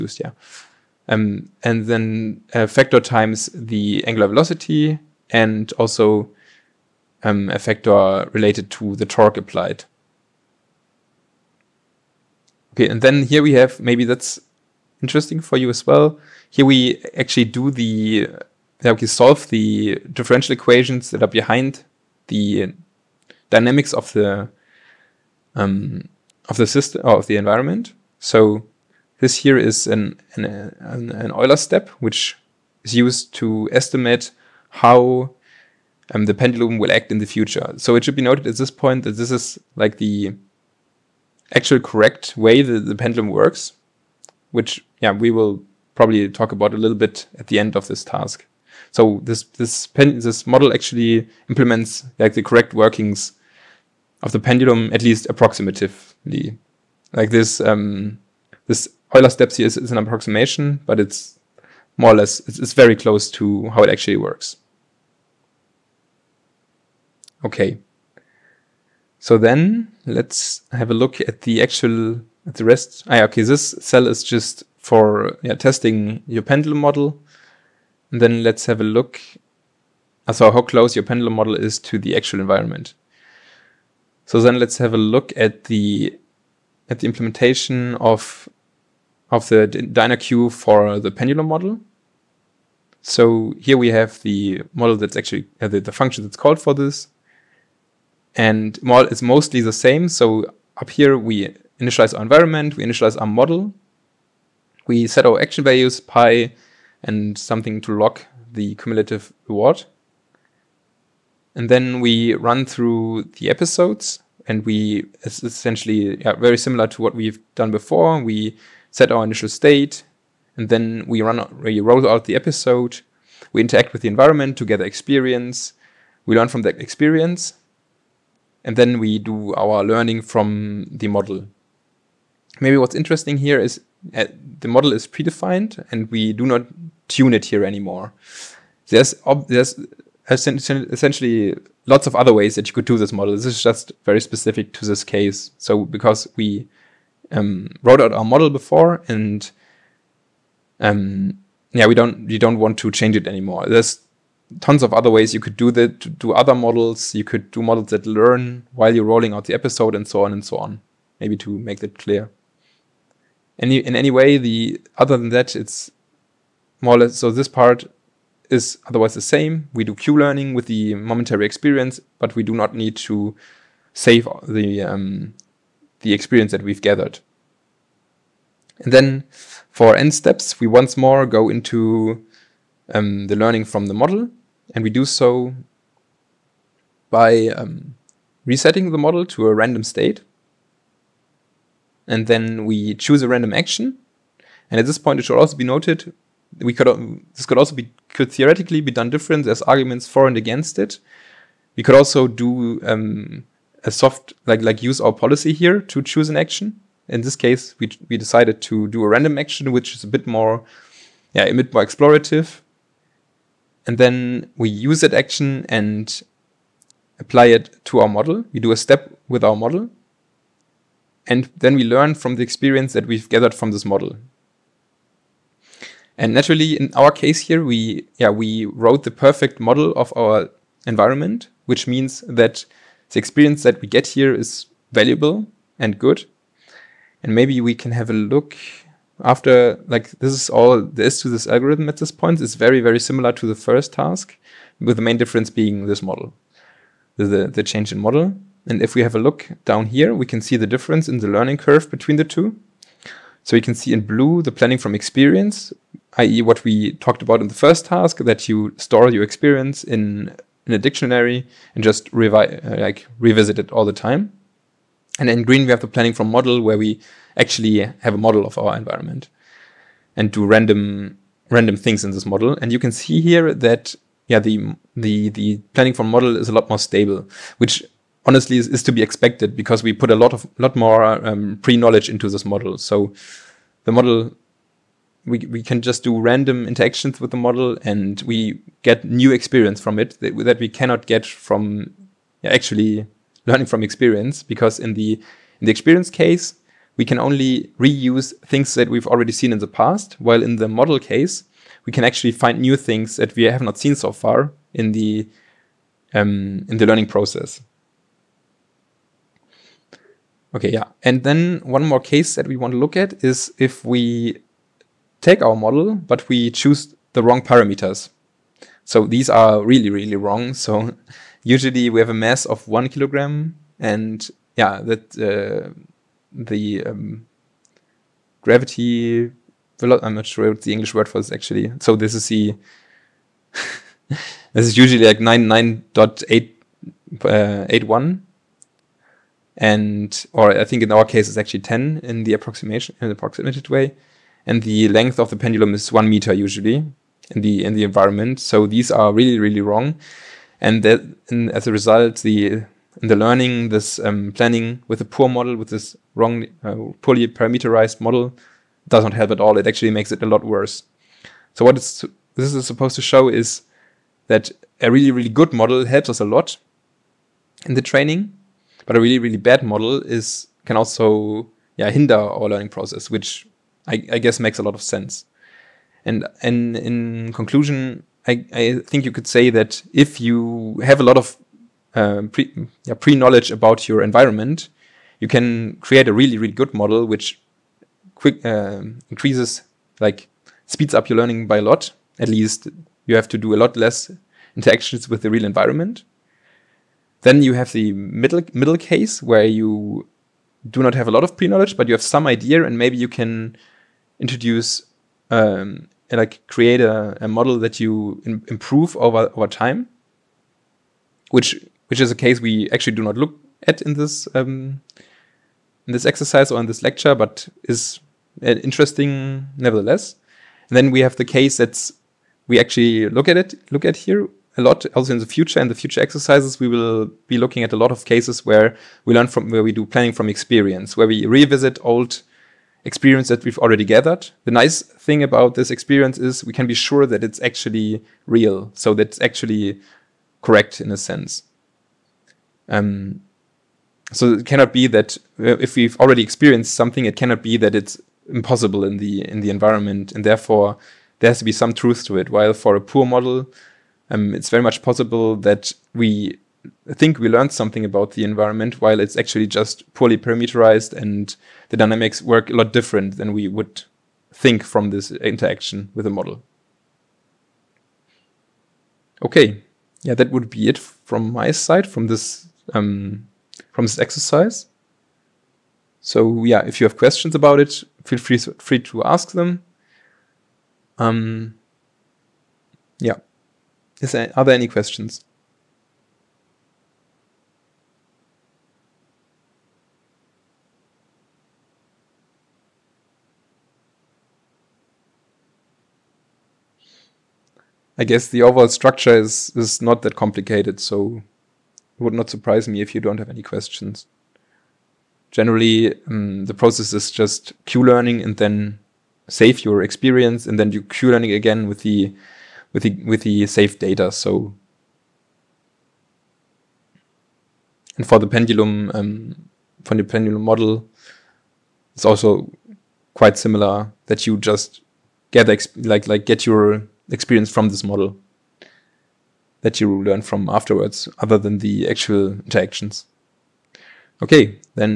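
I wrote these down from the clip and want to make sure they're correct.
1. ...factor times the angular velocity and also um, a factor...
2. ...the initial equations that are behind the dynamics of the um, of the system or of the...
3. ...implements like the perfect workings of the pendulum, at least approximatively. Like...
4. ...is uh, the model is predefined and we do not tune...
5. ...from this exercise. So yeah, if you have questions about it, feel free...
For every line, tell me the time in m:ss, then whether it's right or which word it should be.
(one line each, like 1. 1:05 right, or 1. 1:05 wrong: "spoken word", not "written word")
1. 0:02 right
2. 0:19 wrong: "differential", not "initial"
3. 0:51 wrong: "correct", not "perfect"
4. 2:13 right
5. 7:53 right.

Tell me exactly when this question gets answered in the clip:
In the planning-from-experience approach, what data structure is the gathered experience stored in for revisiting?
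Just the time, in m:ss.
4:20.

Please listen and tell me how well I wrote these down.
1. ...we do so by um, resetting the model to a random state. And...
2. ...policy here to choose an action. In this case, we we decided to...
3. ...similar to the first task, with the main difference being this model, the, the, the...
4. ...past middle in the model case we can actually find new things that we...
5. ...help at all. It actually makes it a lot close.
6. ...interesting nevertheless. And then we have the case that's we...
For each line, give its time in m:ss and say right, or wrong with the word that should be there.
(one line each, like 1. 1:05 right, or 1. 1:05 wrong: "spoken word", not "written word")
1. 3:04 right
2. 3:25 right
3. 4:02 right
4. 4:59 wrong: "while", not "middle"
5. 5:59 wrong: "worse", not "close"
6. 6:58 right.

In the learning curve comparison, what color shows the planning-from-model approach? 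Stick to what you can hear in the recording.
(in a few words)
Green.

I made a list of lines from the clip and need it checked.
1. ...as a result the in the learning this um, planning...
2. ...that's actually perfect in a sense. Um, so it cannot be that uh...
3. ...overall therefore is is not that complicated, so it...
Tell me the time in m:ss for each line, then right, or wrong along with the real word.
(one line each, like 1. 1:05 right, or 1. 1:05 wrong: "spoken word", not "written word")
1. 5:51 right
2. 7:18 wrong: "correct", not "perfect"
3. 8:18 wrong: "structure", not "therefore".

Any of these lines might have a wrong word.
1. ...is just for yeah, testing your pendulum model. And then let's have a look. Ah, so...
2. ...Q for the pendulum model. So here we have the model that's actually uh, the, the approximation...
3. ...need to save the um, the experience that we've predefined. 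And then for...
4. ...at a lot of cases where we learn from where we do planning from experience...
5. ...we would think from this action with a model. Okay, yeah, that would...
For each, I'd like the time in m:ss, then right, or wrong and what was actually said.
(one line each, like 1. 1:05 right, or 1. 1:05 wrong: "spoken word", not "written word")
1. 1:14 right
2. 1:30 wrong: "function", not "approximation"
3. 2:52 wrong: "gathered", not "predefined"
4. 7:07 right
5. 7:43 wrong: "interaction", not "action".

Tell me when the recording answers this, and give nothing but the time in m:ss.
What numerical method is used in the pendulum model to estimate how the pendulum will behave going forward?
0:31.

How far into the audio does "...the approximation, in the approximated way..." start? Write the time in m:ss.
5:42.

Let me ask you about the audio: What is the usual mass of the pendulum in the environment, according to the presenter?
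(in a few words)
1 kilogram.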